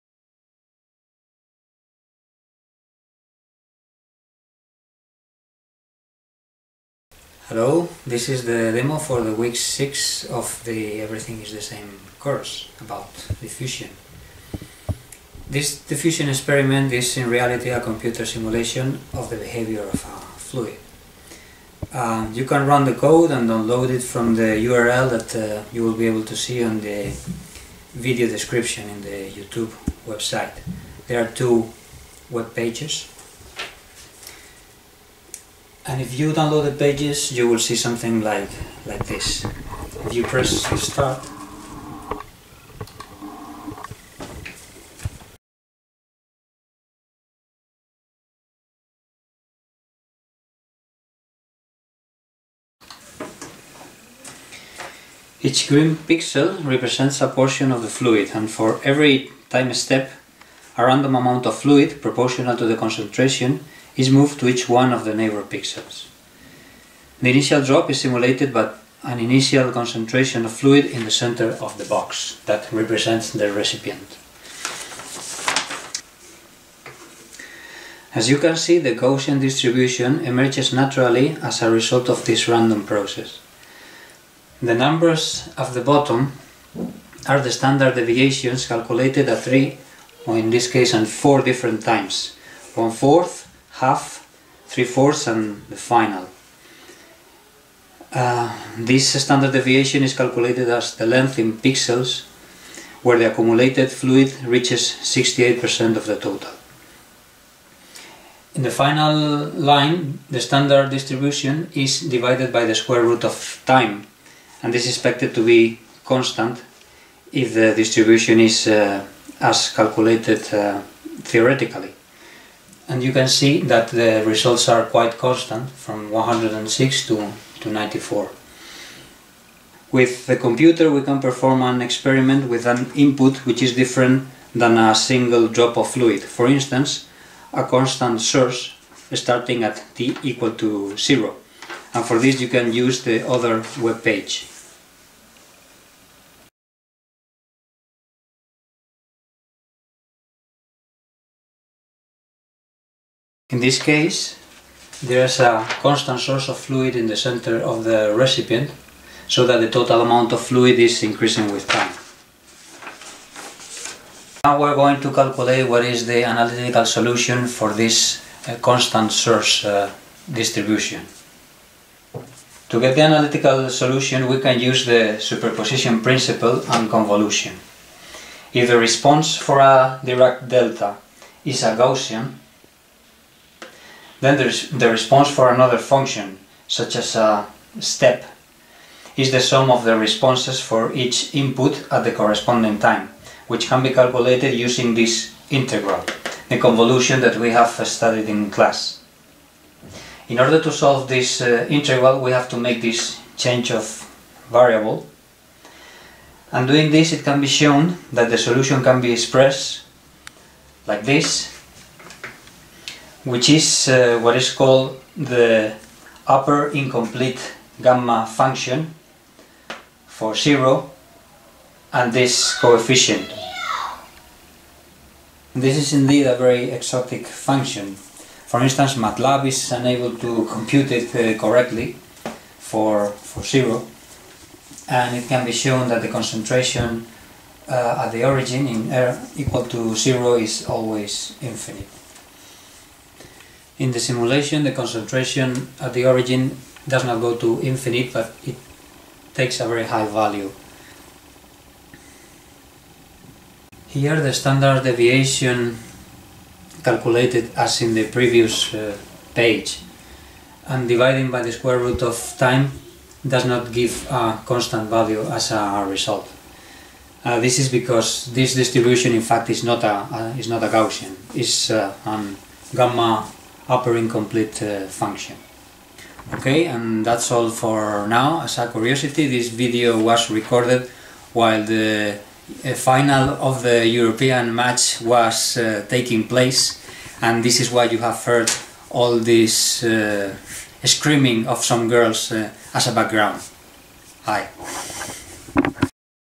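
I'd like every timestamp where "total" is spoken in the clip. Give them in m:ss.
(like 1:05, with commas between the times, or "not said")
1:46, 2:39.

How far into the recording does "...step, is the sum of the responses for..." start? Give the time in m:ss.
3:07.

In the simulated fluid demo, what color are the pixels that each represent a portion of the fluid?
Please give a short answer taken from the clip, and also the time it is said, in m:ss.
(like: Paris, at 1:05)
Green, at 0:55.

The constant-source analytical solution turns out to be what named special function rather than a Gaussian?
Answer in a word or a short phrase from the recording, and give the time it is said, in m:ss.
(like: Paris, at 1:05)
Upper incomplete gamma function, at 3:36.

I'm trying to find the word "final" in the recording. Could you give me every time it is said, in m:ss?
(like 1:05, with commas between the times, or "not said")
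1:35, 1:48, 4:42.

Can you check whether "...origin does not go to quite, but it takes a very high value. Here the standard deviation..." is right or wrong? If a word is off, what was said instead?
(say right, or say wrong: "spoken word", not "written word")
wrong: "infinite", not "quite".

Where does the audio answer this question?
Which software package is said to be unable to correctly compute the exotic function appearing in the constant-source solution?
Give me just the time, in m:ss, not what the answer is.
3:48.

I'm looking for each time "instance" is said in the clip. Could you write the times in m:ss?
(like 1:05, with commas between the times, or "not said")
2:16, 3:48.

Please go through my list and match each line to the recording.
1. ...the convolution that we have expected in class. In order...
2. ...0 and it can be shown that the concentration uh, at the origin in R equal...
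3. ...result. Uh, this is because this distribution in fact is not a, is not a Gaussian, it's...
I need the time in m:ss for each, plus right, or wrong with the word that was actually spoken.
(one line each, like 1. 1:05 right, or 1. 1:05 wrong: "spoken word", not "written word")
1. 3:16 wrong: "studied", not "expected"
2. 3:53 right
3. 4:25 right.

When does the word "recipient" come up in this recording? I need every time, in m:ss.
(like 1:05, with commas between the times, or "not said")
1:13, 2:38.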